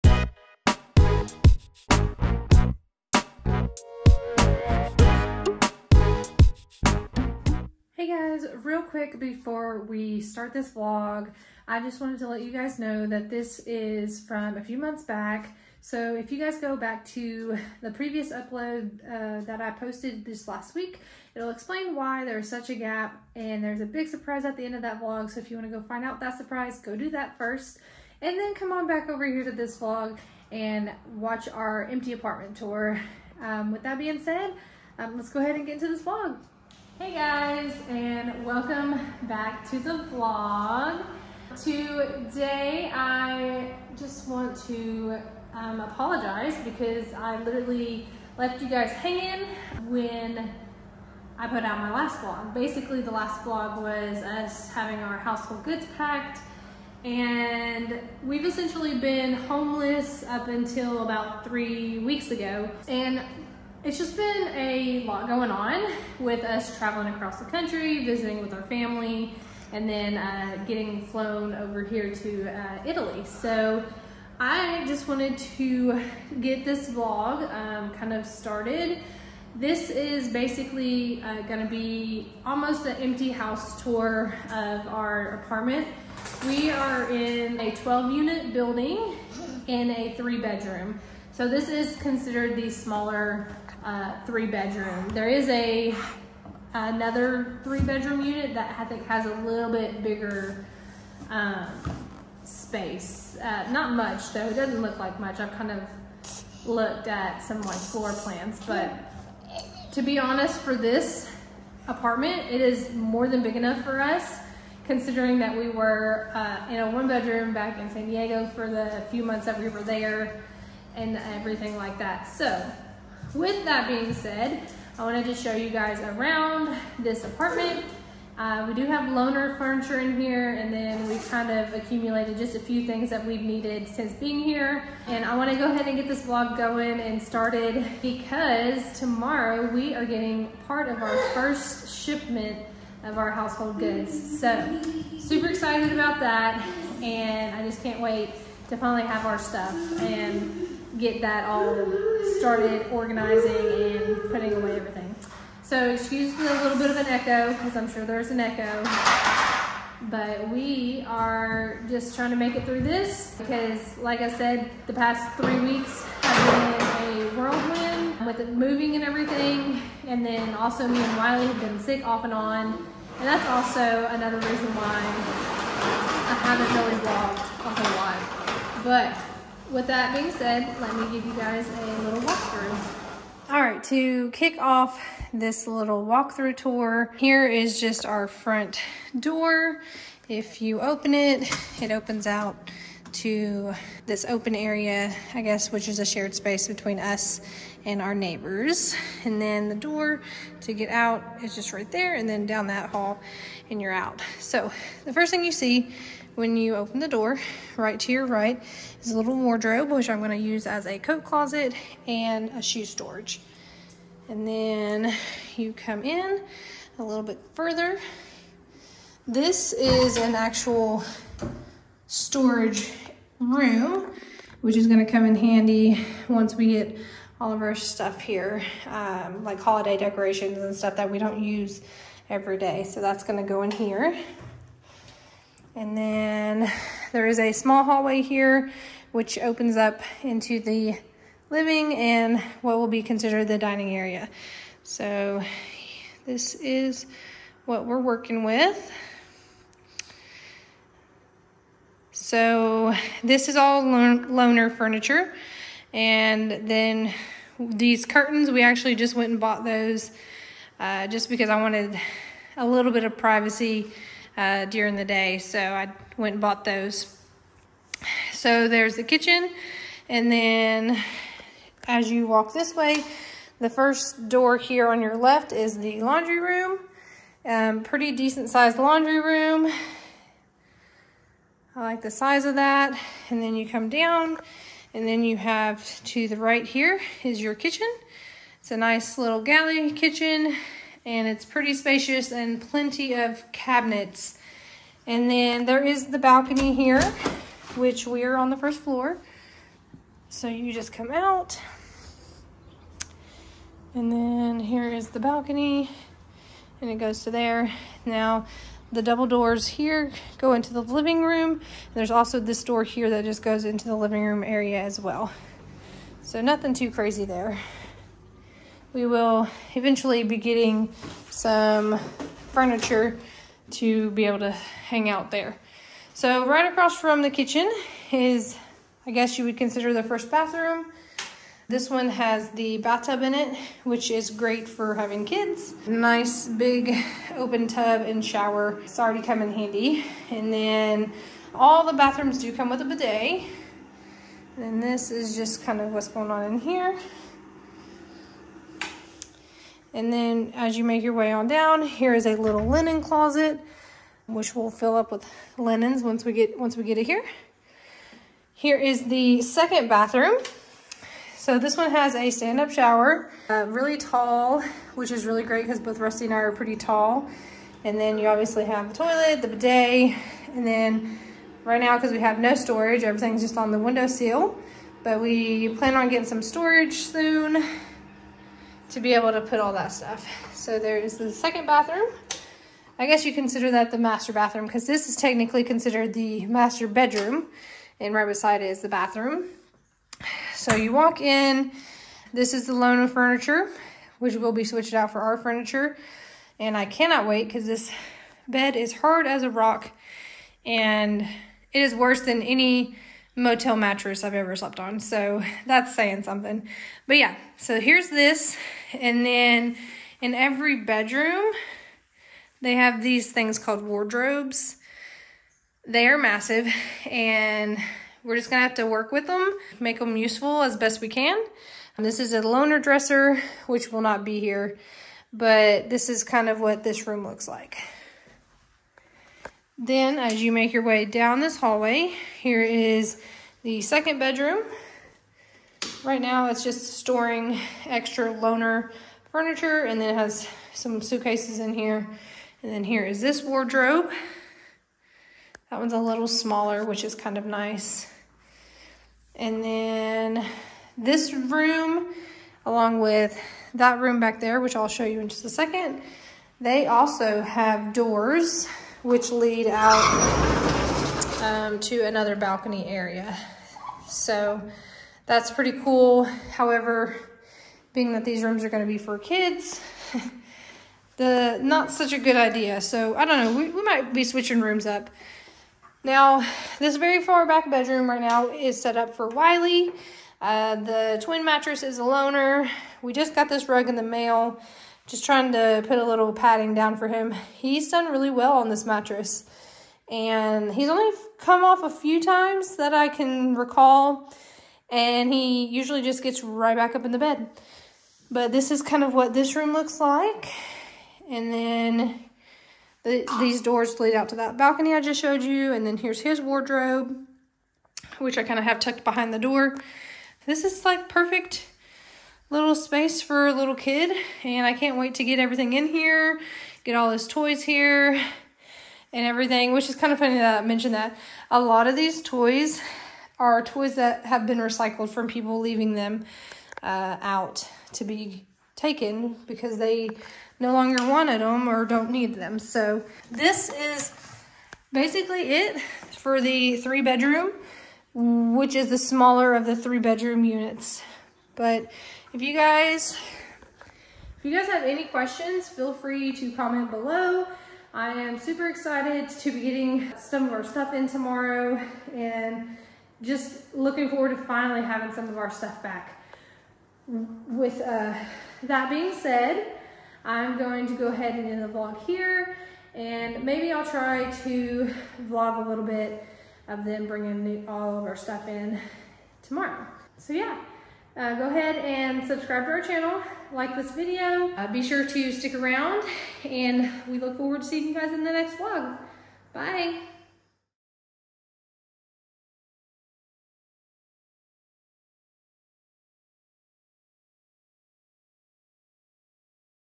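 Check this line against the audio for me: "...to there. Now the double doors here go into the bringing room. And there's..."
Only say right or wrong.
wrong.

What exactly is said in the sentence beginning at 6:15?
But we plan on getting some storage soon to be able to put all that stuff.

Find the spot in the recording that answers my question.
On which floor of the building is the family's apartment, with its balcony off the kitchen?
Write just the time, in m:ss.
4:58.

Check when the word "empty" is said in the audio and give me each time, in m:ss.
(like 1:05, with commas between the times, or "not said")
0:31, 1:22.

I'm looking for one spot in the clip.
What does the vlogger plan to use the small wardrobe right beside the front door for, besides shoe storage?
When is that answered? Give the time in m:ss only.
3:30.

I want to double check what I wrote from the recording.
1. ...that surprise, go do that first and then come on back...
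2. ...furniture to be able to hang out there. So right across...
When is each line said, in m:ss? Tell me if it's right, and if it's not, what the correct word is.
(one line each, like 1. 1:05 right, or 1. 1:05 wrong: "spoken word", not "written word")
1. 0:26 right
2. 5:22 right.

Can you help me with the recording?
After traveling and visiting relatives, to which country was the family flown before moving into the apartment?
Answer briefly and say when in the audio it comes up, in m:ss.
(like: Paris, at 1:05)
Italy, at 1:12.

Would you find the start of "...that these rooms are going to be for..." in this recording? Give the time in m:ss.
7:48.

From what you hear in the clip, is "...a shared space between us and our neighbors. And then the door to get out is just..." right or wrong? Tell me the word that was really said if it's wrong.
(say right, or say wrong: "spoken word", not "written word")
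right.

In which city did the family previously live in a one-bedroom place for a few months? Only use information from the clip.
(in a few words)
San Diego.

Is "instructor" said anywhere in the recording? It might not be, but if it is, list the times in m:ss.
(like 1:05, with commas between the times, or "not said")
not said.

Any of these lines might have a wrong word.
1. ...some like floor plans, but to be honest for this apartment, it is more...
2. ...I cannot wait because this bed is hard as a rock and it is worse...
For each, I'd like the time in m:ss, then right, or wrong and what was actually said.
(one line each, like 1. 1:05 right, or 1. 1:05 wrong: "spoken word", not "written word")
1. 1:47 right
2. 6:36 right.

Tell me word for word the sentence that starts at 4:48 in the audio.
It's a nice little galley kitchen and it's pretty spacious and plenty of cabinets.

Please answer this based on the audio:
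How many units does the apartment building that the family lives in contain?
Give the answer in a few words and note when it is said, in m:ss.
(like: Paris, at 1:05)
12, at 1:27.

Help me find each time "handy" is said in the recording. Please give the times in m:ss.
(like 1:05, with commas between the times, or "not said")
3:45, 5:39.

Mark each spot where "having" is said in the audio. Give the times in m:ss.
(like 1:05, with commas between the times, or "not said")
0:54, 5:34, 9:14.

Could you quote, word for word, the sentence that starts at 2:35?
So excuse me a little bit of an echo because I'm sure there's an echo.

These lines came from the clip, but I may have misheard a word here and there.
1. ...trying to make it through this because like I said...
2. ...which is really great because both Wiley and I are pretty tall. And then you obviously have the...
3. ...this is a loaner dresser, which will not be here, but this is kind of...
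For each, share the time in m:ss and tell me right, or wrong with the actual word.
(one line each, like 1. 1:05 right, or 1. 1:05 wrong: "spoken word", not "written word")
1. 2:42 right
2. 6:04 wrong: "Rusty", not "Wiley"
3. 7:02 right.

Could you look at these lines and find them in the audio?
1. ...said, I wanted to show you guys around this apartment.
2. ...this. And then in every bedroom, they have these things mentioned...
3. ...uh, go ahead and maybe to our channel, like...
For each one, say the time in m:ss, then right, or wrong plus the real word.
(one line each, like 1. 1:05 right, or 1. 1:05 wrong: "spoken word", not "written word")
1. 2:04 right
2. 6:48 wrong: "called", not "mentioned"
3. 9:31 wrong: "subscribe", not "maybe".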